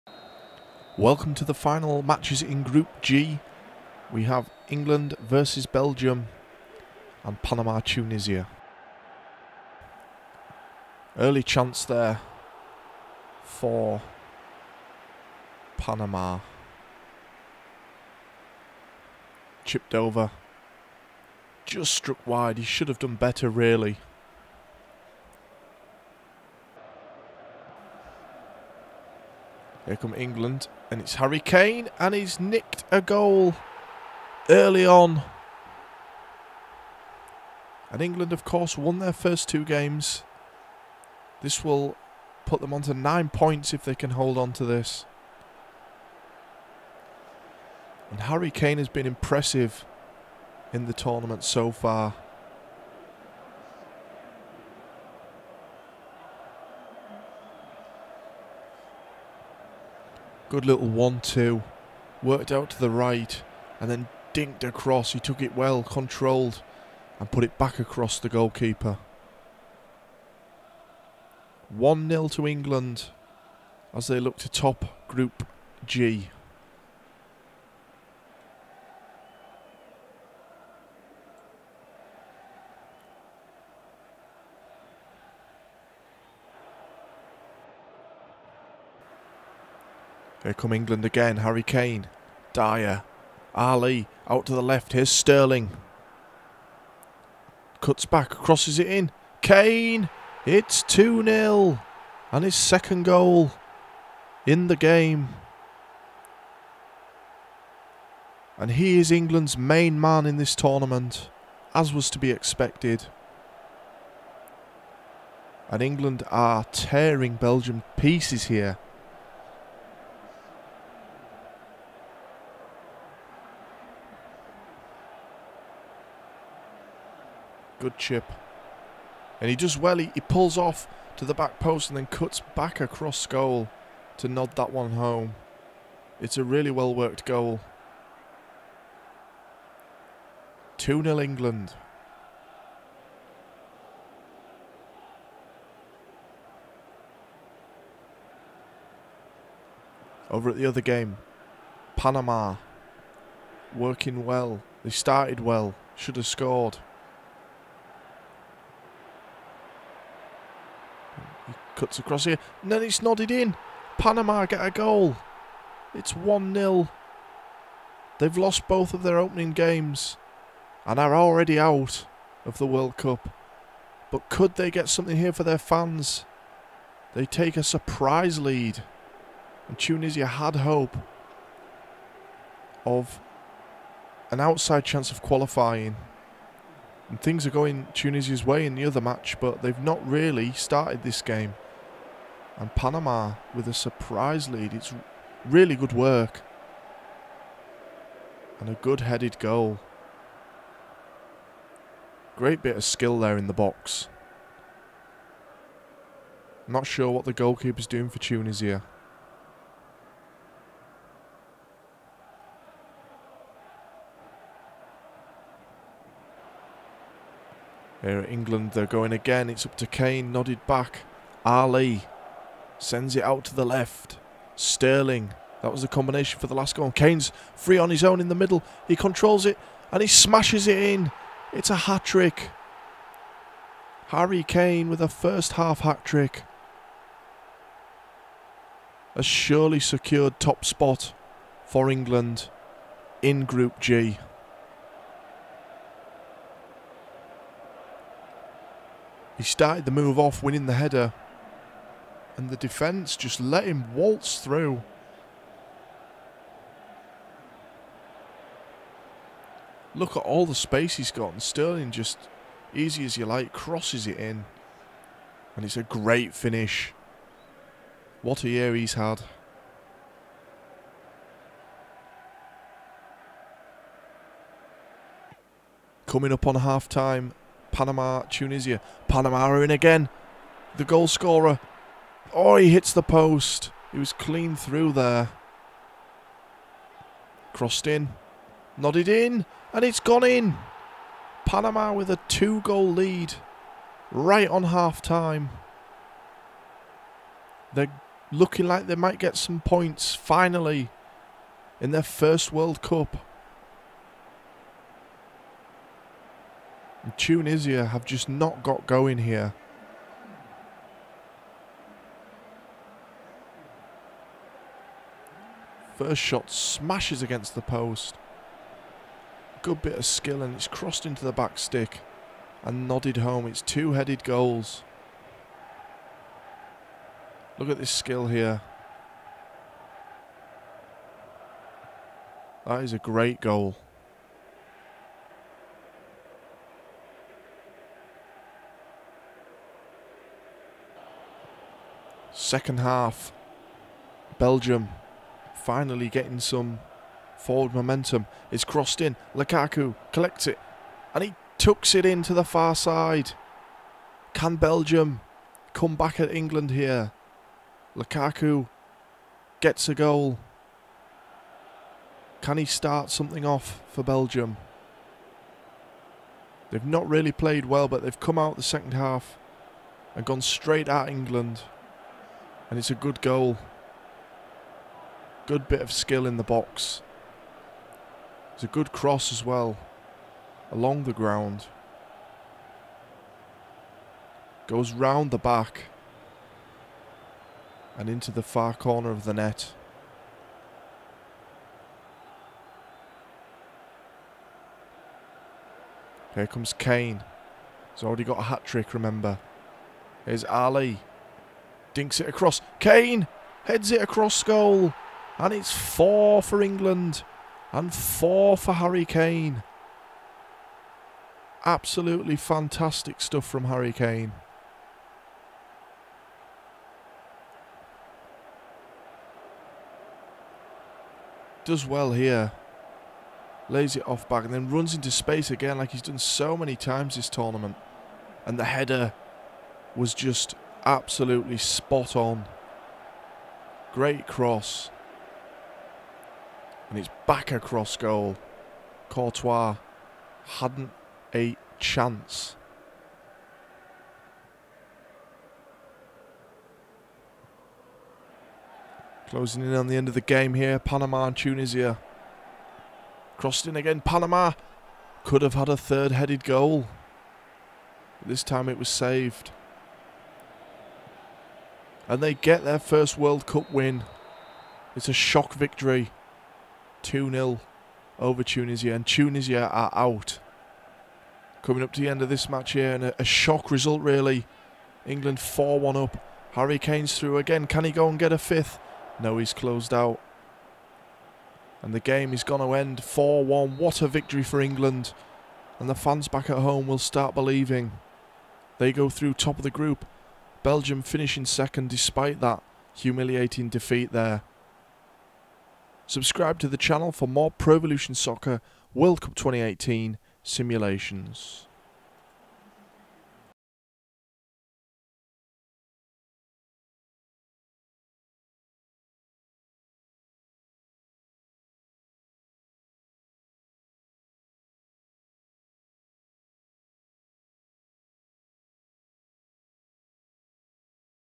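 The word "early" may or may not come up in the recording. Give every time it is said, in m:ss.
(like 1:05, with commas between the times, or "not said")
0:11, 0:34.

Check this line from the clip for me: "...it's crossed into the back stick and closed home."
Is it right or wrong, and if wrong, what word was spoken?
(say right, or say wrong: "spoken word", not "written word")
wrong: "nodded", not "closed".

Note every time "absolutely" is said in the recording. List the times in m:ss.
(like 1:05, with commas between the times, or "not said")
6:51, 7:10.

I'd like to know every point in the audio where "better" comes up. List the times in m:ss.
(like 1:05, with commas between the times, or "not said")
0:23.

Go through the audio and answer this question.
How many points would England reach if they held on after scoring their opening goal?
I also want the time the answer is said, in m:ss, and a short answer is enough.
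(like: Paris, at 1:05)
9, at 0:42.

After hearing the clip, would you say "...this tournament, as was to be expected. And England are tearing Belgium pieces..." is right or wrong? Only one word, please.
right.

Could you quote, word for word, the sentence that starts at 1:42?
And his second goal in the game.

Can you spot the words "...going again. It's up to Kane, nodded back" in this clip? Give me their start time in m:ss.
3:38.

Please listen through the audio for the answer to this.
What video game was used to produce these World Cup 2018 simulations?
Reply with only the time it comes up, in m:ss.
8:17.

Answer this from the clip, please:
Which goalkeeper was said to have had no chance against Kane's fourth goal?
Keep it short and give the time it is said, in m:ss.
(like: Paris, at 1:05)
Courtois, at 7:19.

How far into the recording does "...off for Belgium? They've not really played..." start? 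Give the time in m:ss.
6:03.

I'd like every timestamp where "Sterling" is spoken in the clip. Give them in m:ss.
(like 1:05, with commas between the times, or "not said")
1:35, 3:44, 4:21.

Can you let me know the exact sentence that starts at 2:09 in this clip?
He, he pulls off to the back post and then cuts back across goal to nod that one home.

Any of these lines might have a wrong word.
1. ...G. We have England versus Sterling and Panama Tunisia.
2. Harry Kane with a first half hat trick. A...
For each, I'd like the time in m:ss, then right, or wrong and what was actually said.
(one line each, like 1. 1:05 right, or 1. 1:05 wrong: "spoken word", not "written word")
1. 0:03 wrong: "Belgium", not "Sterling"
2. 3:54 right.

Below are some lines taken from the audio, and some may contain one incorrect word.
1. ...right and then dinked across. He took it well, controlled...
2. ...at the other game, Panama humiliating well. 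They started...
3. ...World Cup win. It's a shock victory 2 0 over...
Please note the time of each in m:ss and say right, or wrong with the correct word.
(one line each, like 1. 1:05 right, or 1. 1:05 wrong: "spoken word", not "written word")
1. 1:02 right
2. 2:30 wrong: "working", not "humiliating"
3. 7:43 right.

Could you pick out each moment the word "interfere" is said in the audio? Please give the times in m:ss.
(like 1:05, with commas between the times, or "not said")
not said.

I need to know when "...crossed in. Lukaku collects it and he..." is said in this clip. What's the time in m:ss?
5:48.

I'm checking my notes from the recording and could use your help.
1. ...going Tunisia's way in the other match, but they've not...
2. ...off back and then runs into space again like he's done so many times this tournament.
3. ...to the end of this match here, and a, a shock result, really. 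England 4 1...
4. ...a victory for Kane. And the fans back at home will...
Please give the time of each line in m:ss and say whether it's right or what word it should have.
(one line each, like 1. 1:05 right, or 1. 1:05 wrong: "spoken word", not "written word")
1. 3:07 right
2. 7:04 right
3. 7:51 right
4. 8:04 wrong: "England", not "Kane".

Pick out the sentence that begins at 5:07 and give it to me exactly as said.
And Tunisia have just not got going here.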